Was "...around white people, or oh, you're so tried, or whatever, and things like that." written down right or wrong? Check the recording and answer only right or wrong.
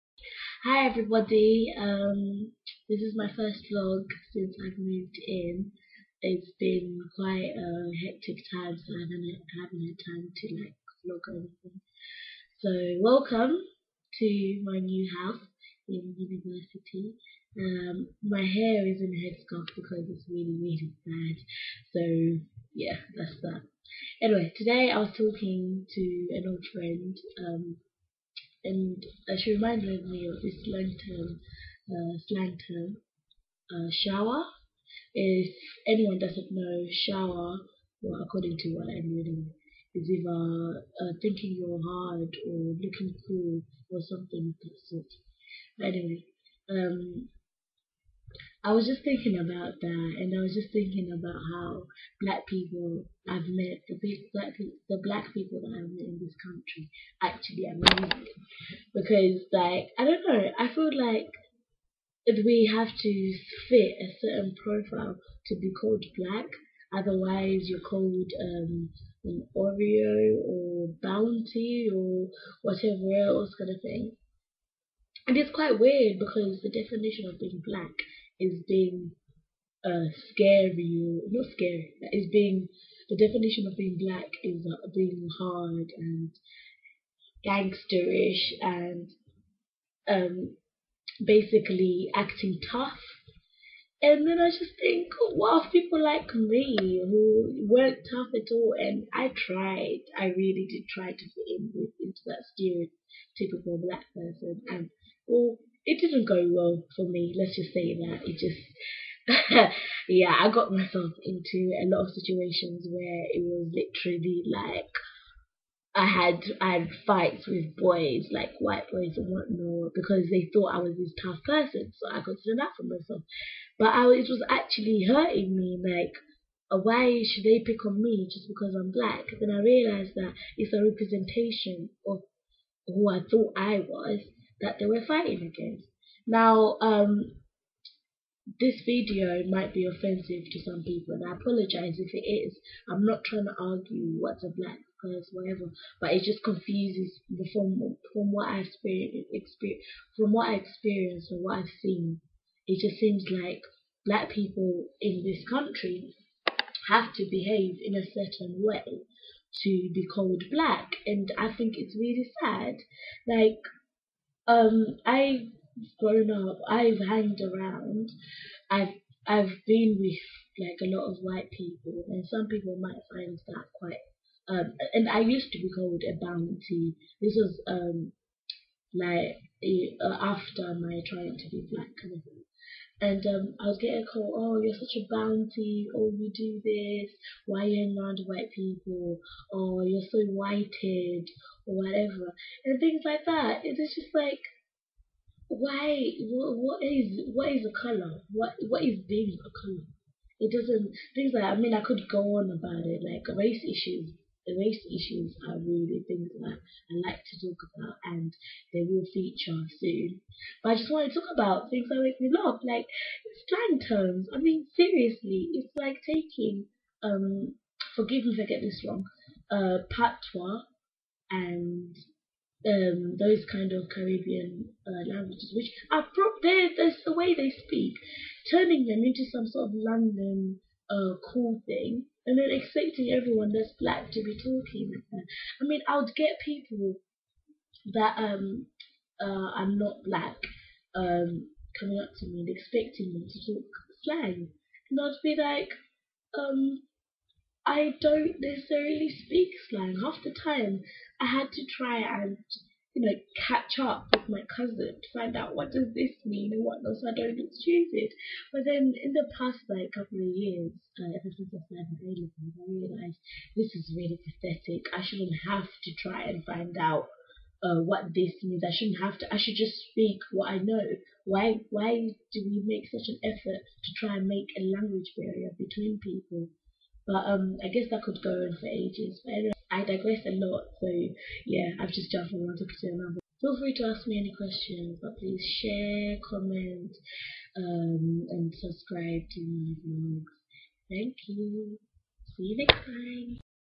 wrong.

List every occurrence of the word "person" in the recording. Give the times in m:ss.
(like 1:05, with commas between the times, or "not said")
1:44, 2:01.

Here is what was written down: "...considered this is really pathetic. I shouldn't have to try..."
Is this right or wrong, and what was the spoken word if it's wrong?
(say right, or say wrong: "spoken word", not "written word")
wrong: "realised", not "considered".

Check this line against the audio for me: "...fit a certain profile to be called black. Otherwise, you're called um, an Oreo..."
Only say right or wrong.
right.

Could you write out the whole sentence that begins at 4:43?
Feel free to ask me any questions, but please share, comment, um, and subscribe to my vlogs.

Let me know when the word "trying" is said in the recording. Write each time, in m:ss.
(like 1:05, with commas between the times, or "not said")
2:23, 3:01.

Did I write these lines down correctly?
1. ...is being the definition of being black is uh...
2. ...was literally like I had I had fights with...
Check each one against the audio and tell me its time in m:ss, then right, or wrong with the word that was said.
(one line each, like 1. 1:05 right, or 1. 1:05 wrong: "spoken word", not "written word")
1. 1:22 right
2. 1:53 right.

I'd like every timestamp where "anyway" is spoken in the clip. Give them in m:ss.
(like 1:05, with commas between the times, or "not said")
0:24, 0:45, 4:39.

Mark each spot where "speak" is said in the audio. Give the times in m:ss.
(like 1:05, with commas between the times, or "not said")
3:47, 4:09, 4:29.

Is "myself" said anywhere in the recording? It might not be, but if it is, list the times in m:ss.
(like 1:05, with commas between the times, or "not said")
1:50, 2:02.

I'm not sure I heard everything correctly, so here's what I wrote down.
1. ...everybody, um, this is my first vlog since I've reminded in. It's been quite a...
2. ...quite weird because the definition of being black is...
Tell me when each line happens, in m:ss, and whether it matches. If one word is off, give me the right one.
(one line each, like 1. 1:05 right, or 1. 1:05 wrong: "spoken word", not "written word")
1. 0:00 wrong: "moved", not "reminded"
2. 1:15 right.